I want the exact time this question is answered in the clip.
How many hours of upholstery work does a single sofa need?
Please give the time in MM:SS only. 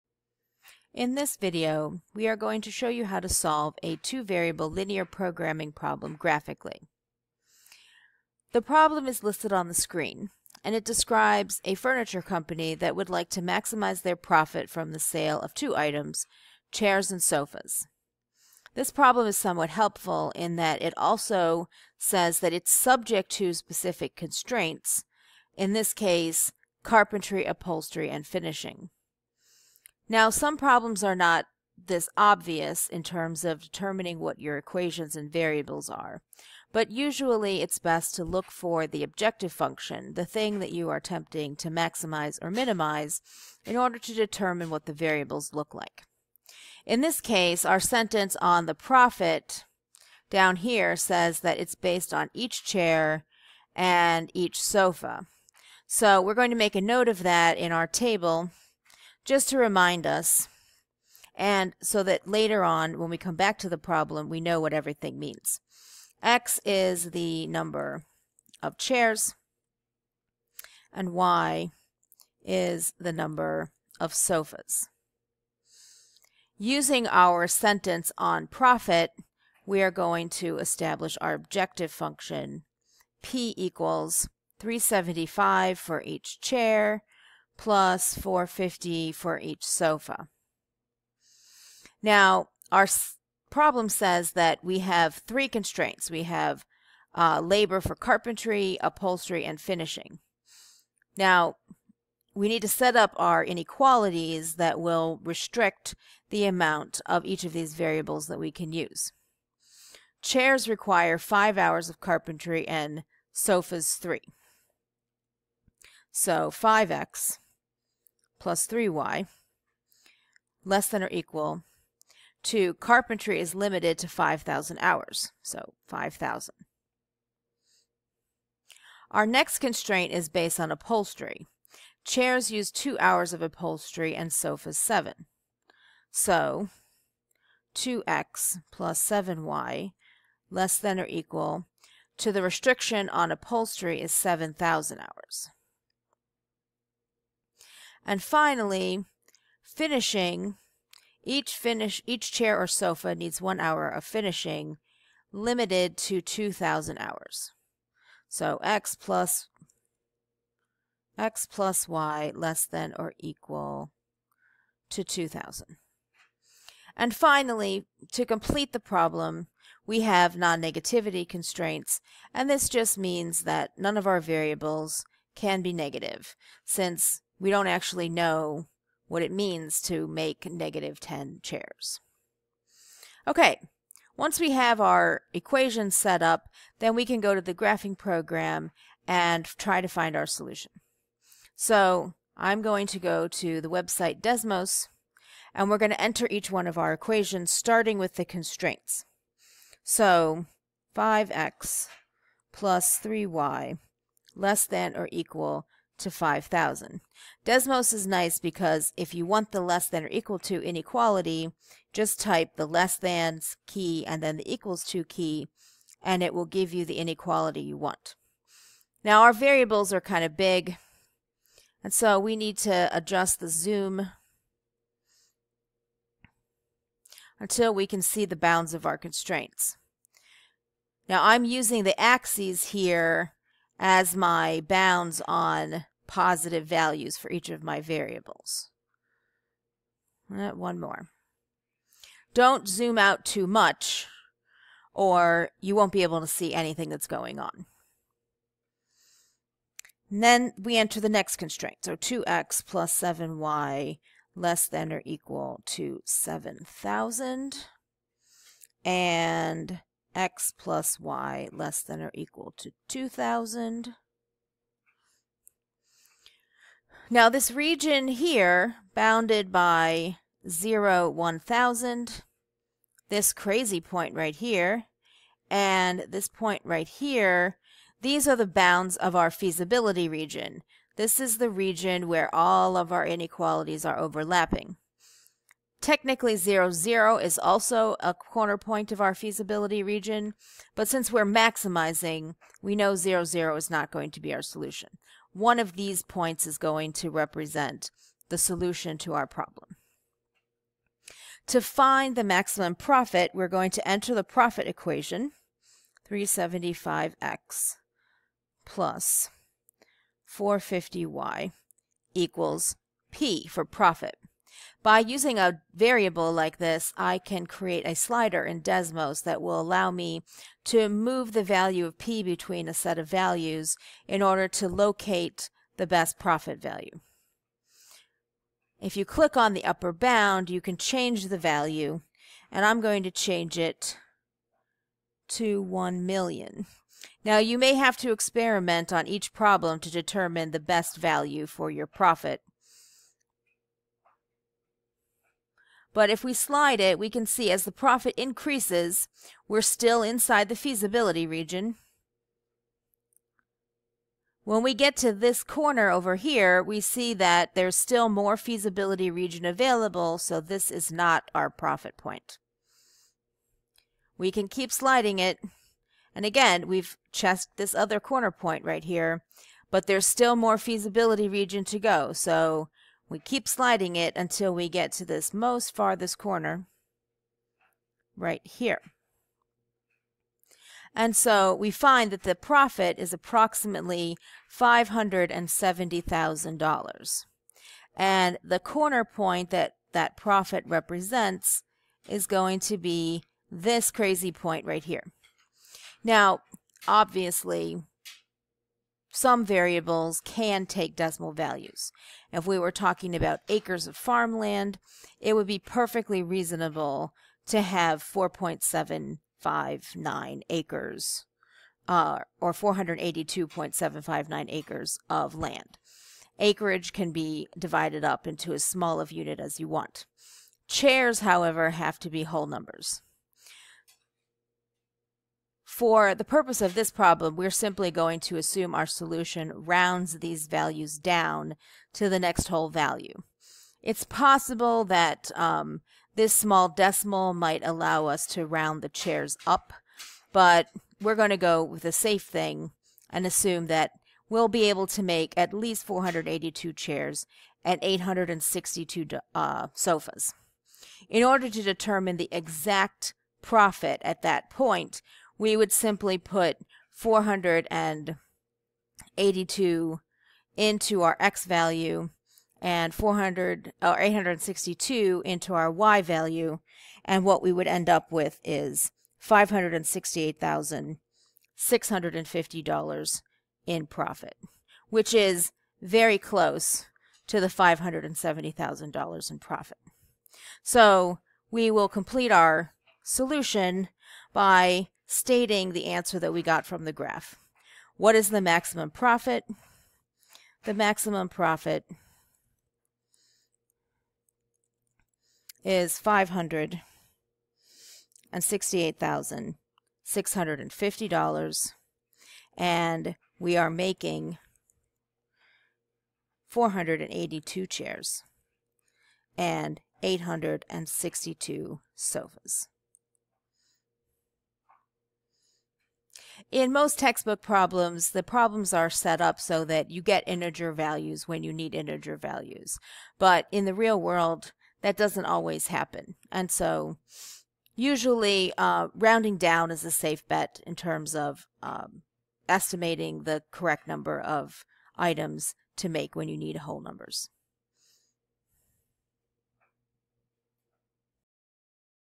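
02:14.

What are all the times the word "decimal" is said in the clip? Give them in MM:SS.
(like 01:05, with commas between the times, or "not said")
06:40, 07:16.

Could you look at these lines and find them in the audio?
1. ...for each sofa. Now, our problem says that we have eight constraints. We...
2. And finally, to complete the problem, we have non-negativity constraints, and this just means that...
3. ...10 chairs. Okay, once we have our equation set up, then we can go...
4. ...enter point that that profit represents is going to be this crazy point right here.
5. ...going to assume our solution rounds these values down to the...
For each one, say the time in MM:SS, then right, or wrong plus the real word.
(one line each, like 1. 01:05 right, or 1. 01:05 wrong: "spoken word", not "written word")
1. 01:29 wrong: "three", not "eight"
2. 02:46 right
3. 03:00 right
4. 06:28 wrong: "corner", not "enter"
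5. 07:07 right.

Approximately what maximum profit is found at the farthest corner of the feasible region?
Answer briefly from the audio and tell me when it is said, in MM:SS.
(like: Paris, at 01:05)
$570,000, at 06:24.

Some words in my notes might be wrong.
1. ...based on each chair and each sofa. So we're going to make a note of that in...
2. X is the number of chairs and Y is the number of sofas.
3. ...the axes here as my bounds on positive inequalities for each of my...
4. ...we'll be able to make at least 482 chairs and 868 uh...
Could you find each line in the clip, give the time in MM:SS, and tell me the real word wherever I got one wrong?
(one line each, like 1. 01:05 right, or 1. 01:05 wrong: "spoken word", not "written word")
1. 00:51 right
2. 01:06 right
3. 03:51 wrong: "values", not "inequalities"
4. 07:24 wrong: "862", not "868".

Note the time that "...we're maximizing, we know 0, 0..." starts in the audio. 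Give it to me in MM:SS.
04:51.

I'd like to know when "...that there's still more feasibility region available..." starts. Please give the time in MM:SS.
05:57.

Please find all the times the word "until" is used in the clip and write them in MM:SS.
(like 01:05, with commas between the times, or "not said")
03:47, 06:14.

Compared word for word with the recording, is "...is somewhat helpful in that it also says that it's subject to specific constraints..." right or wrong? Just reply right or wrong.
right.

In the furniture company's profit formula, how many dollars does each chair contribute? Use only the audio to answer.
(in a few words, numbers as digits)
375.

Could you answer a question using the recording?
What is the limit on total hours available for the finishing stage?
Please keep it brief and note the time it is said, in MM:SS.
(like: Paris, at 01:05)
2000 hours, at 02:36.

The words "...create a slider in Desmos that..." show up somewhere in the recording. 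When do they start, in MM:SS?
05:17.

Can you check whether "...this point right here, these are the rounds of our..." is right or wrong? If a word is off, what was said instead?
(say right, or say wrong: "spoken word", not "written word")
wrong: "bounds", not "rounds".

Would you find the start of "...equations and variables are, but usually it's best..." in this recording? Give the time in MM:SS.
00:34.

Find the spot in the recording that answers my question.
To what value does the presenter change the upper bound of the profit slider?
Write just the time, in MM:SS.
05:35.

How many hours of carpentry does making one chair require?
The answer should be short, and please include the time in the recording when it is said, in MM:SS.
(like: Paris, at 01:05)
5, at 01:51.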